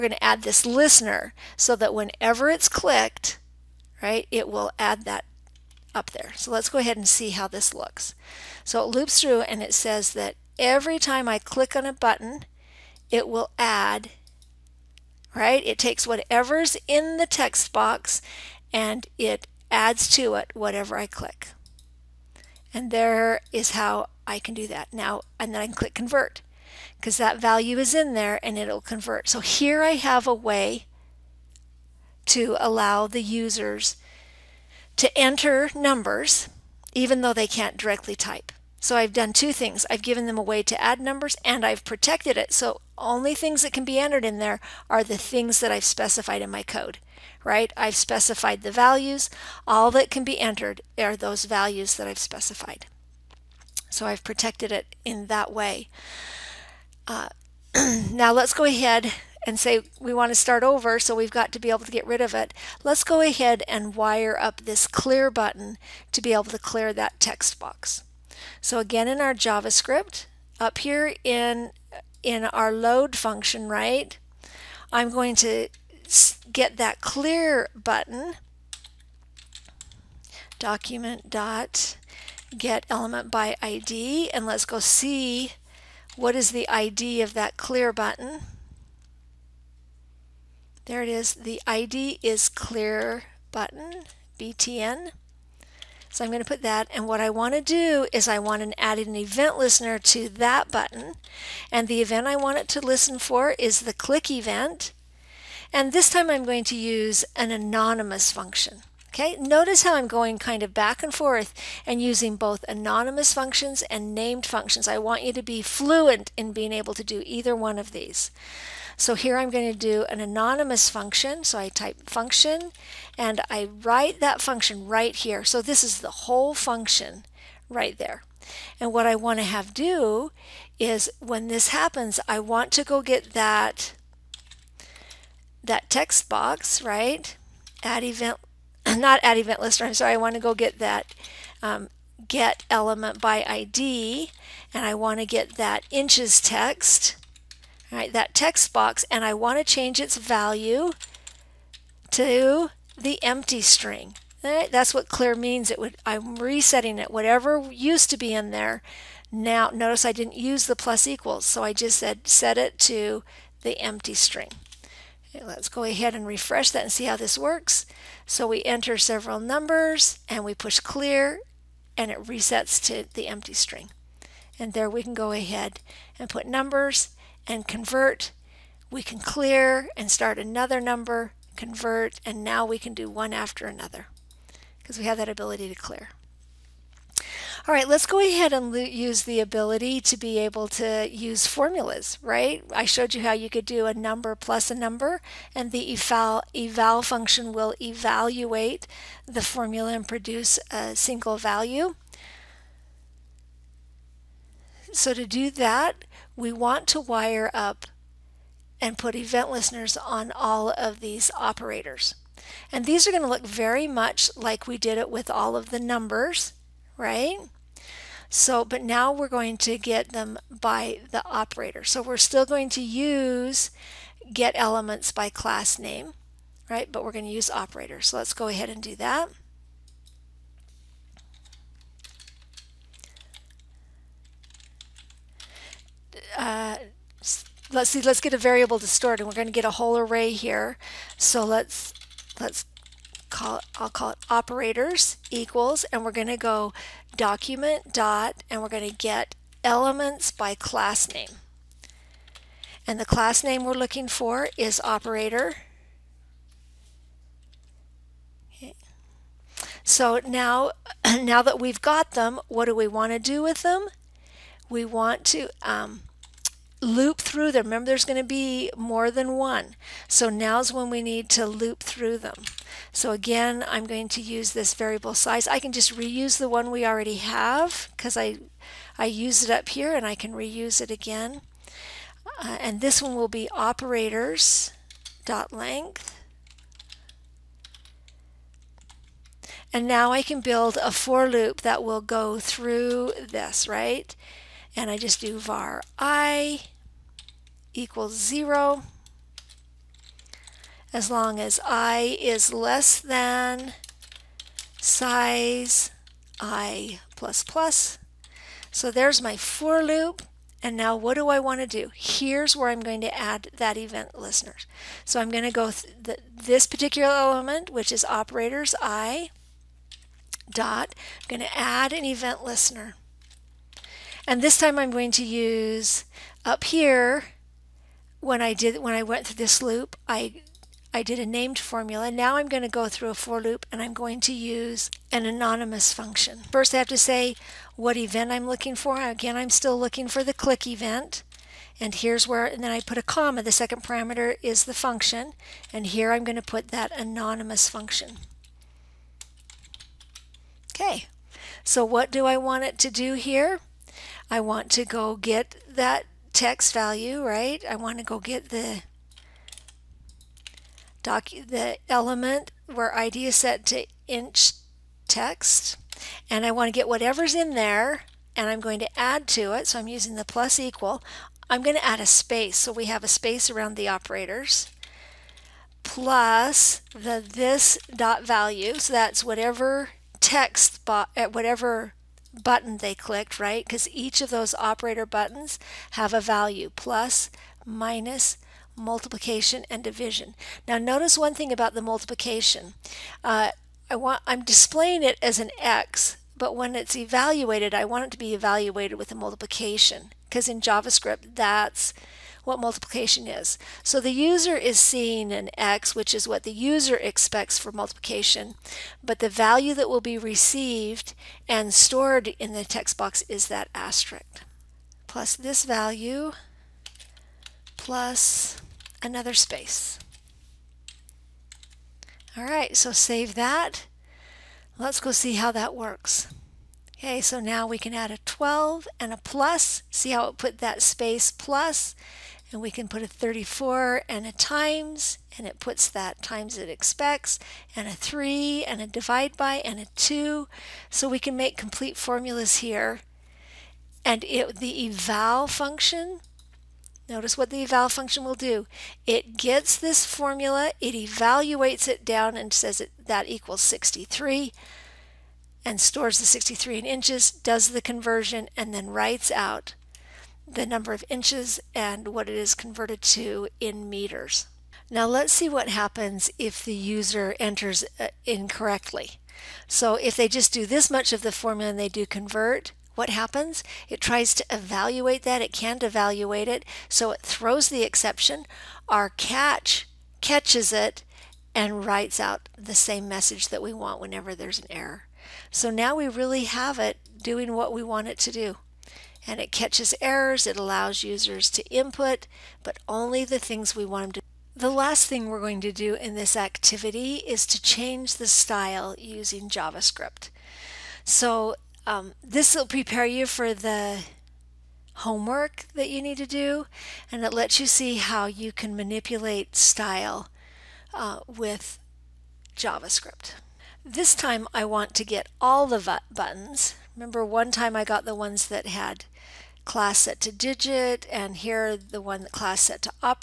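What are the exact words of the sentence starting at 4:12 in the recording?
And the class name we're looking for is operator.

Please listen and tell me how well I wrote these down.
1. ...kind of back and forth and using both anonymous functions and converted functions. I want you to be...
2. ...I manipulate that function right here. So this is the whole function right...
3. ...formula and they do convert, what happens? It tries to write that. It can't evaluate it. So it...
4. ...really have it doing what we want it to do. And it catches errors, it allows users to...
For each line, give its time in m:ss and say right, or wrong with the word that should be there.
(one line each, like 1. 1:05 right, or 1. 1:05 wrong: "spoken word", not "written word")
1. 1:50 wrong: "named", not "converted"
2. 2:03 wrong: "write", not "manipulate"
3. 7:51 wrong: "evaluate", not "write"
4. 8:06 right.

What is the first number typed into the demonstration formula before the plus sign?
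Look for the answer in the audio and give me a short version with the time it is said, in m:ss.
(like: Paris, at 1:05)
12, at 7:08.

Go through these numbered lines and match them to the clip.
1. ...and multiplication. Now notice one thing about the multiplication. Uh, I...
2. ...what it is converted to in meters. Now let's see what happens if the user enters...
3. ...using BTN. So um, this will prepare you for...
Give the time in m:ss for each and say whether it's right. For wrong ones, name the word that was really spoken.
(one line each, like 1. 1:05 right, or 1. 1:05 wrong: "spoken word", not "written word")
1. 6:29 wrong: "division", not "multiplication"
2. 7:42 right
3. 8:18 wrong: "JavaScript", not "BTN".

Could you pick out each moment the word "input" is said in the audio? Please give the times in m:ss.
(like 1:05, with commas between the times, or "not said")
8:11.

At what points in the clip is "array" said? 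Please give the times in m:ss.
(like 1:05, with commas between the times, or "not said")
3:59.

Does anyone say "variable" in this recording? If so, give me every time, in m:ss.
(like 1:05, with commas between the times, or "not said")
3:58, 4:34.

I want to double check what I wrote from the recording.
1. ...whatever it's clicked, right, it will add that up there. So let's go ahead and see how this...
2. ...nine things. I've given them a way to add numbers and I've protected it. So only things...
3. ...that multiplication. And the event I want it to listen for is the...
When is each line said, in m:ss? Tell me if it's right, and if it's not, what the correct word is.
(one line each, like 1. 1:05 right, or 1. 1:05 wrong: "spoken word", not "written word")
1. 0:01 wrong: "whenever", not "whatever"
2. 0:39 wrong: "two", not "nine"
3. 1:40 wrong: "button", not "multiplication".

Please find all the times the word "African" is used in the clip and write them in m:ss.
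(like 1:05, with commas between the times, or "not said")
not said.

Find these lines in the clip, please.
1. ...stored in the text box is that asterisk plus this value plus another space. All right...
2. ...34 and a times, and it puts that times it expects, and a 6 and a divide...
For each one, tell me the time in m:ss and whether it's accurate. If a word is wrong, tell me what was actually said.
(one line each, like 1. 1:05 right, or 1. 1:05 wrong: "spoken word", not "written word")
1. 6:51 right
2. 7:13 wrong: "3", not "6".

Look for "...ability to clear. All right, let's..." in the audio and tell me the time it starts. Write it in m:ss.
3:05.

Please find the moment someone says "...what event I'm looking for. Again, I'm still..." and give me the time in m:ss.
5:37.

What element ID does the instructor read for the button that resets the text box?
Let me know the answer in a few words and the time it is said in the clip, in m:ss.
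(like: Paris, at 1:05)
clear button, BTN, at 1:32.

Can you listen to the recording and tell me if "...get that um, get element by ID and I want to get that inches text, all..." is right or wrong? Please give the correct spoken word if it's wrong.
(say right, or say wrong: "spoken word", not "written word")
right.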